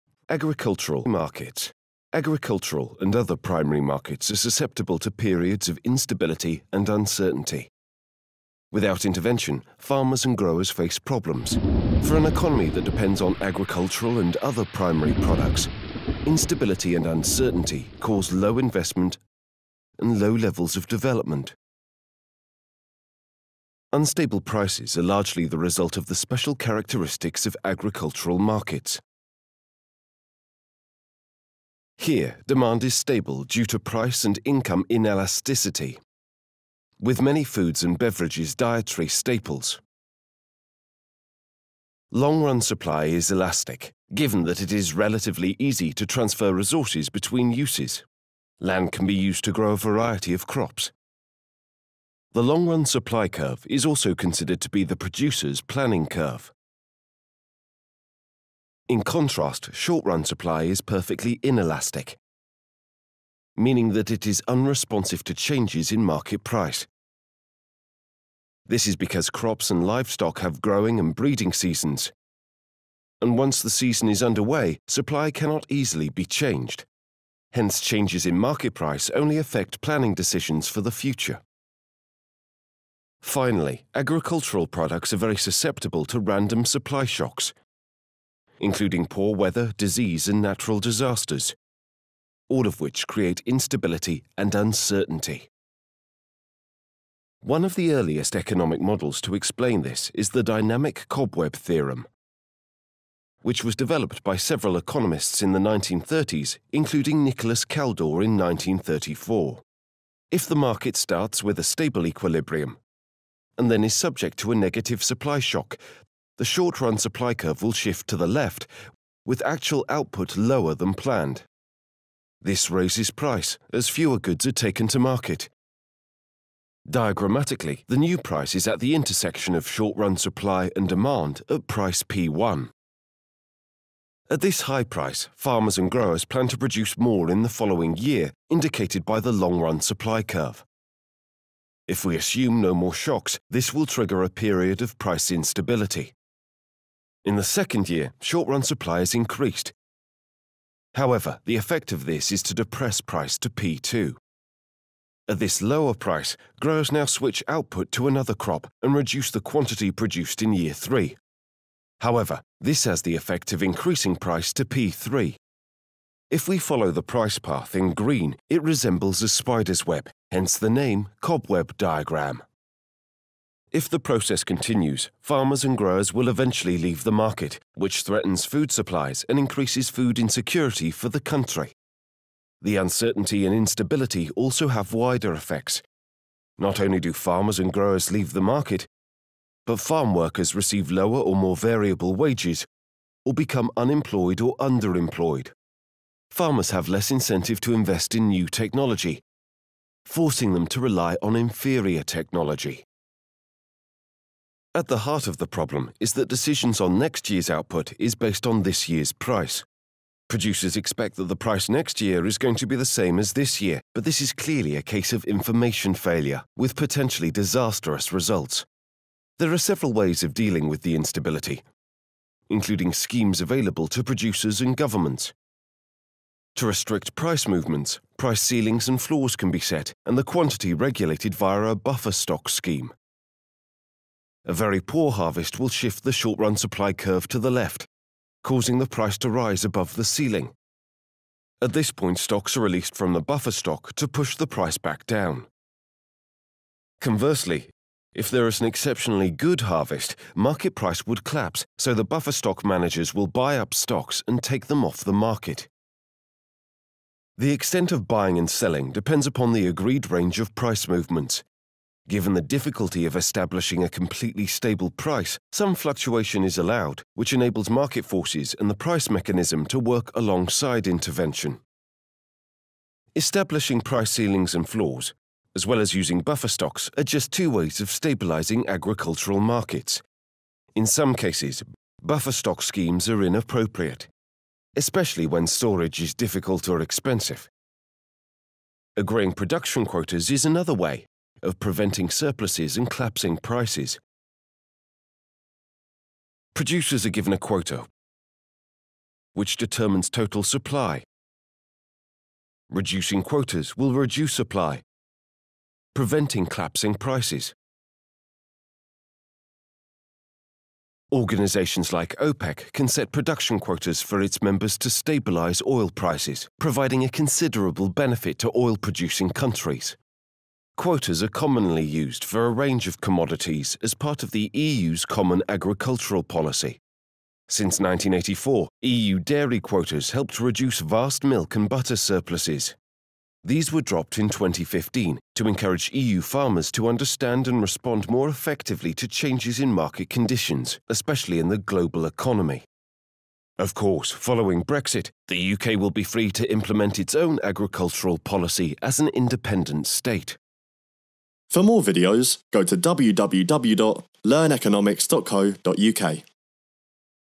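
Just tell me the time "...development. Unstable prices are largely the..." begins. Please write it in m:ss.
0:20.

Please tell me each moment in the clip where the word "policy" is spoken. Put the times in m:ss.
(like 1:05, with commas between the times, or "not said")
5:26, 5:48.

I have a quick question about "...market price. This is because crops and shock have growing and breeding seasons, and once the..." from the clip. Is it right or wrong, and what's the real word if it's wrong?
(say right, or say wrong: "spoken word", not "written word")
wrong: "livestock", not "shock".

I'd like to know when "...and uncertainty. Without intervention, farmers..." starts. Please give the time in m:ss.
0:06.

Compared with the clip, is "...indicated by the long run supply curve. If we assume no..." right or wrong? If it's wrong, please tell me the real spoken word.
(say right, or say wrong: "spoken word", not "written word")
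right.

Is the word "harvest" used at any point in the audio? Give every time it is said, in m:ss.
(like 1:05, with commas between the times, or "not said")
3:55, 4:09.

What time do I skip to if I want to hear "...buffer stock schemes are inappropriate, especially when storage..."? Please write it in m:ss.
4:42.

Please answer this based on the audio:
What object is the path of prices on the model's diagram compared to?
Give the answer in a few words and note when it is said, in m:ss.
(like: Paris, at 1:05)
a spider's web, at 2:49.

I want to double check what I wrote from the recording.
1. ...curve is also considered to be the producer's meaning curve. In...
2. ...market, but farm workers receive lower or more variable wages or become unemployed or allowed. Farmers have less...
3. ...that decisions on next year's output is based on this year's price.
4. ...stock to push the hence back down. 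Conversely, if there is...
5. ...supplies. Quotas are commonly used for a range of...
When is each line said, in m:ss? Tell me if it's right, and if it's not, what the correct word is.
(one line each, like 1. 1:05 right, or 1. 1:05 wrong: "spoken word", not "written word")
1. 0:53 wrong: "planning", not "meaning"
2. 3:08 wrong: "underemployed", not "allowed"
3. 3:26 right
4. 4:03 wrong: "price", not "hence"
5. 5:19 wrong: "countries", not "supplies".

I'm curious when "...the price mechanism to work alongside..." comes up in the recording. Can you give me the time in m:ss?
4:28.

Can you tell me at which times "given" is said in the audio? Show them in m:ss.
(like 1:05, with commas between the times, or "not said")
0:44, 4:22, 4:57.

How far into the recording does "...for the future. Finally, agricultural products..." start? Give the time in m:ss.
1:20.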